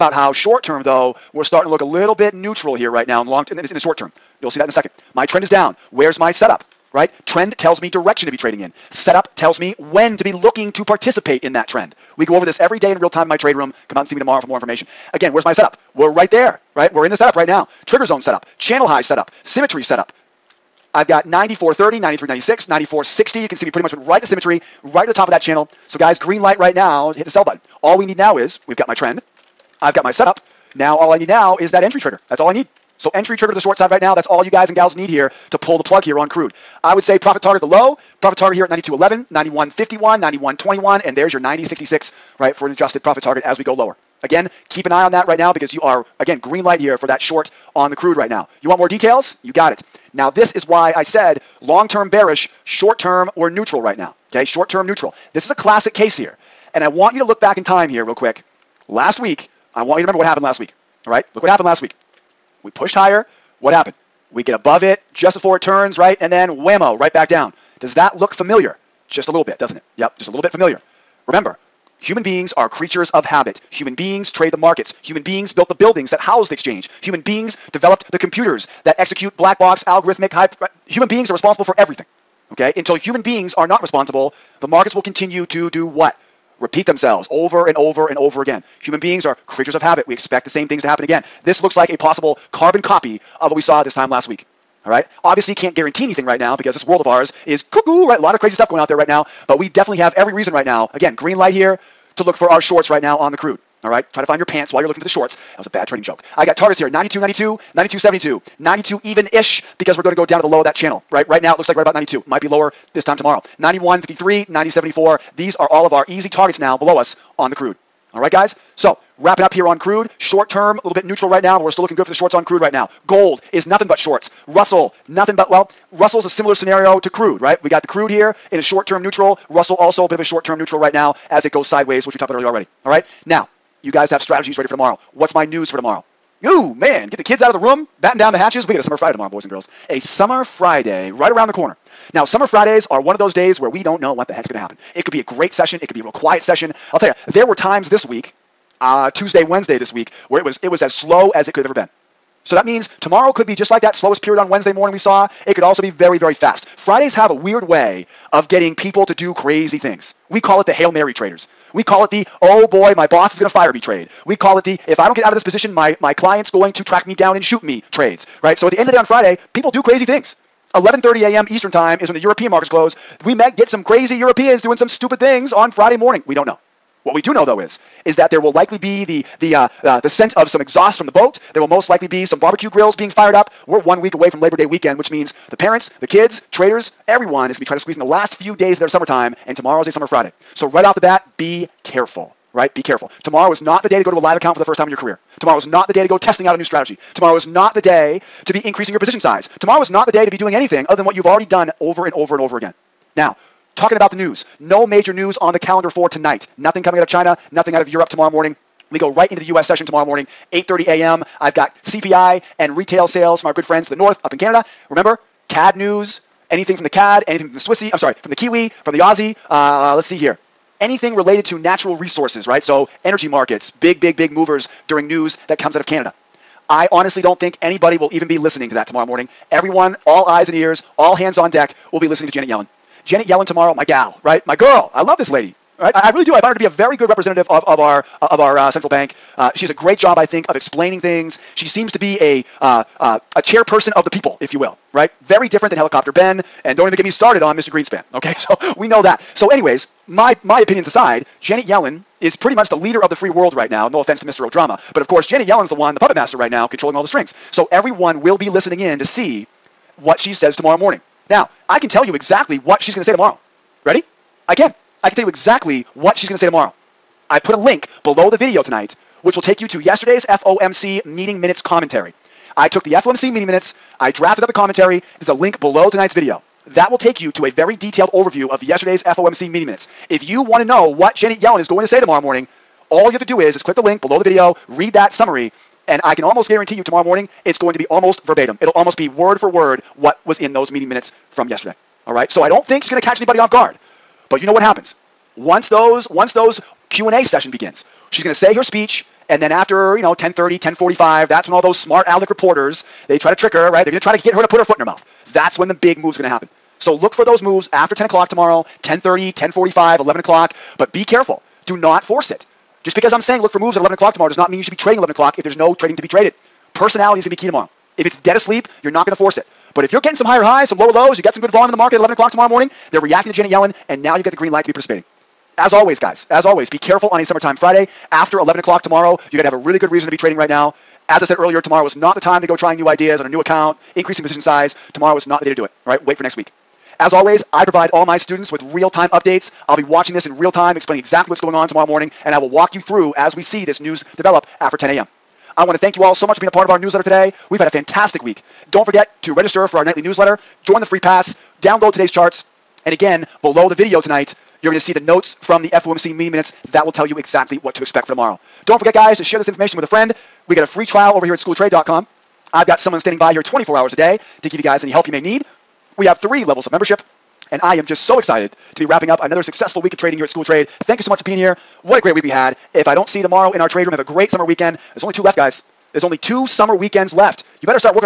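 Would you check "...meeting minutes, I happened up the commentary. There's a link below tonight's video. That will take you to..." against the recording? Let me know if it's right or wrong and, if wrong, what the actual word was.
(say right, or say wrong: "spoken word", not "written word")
wrong: "drafted", not "happened".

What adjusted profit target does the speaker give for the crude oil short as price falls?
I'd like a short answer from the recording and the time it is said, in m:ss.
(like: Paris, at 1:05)
90.66, at 0:41.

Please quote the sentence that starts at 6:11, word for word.
What a great week we had, if I don't see you tomorrow in our trade room, have a great summer weekend.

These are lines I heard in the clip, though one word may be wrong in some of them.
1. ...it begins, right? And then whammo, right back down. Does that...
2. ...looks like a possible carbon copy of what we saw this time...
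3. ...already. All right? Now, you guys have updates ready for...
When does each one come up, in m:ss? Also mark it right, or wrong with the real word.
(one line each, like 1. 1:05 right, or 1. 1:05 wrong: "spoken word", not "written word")
1. 1:05 wrong: "turns", not "begins"
2. 1:31 right
3. 2:12 wrong: "strategies", not "updates".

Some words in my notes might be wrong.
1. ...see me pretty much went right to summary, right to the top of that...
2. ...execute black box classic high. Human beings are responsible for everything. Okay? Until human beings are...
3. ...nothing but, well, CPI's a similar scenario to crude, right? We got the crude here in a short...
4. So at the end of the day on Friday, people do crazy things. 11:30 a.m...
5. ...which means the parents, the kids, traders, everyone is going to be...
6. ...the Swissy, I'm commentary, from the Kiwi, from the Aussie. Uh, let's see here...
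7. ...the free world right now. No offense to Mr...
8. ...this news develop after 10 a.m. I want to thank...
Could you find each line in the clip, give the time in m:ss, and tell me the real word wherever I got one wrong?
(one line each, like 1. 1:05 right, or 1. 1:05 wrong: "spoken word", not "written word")
1. 0:23 wrong: "symmetry", not "summary"
2. 1:18 wrong: "algorithmic", not "classic"
3. 2:05 wrong: "Russell", not "CPI"
4. 2:48 right
5. 3:04 right
6. 3:37 wrong: "sorry", not "commentary"
7. 4:13 right
8. 5:43 right.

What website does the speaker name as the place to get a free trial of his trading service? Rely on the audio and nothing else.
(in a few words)
schooltrade.com.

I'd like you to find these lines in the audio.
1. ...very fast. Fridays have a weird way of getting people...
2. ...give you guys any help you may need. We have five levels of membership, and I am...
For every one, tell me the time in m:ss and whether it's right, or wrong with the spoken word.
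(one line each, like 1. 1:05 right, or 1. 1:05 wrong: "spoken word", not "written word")
1. 2:36 right
2. 6:04 wrong: "three", not "five".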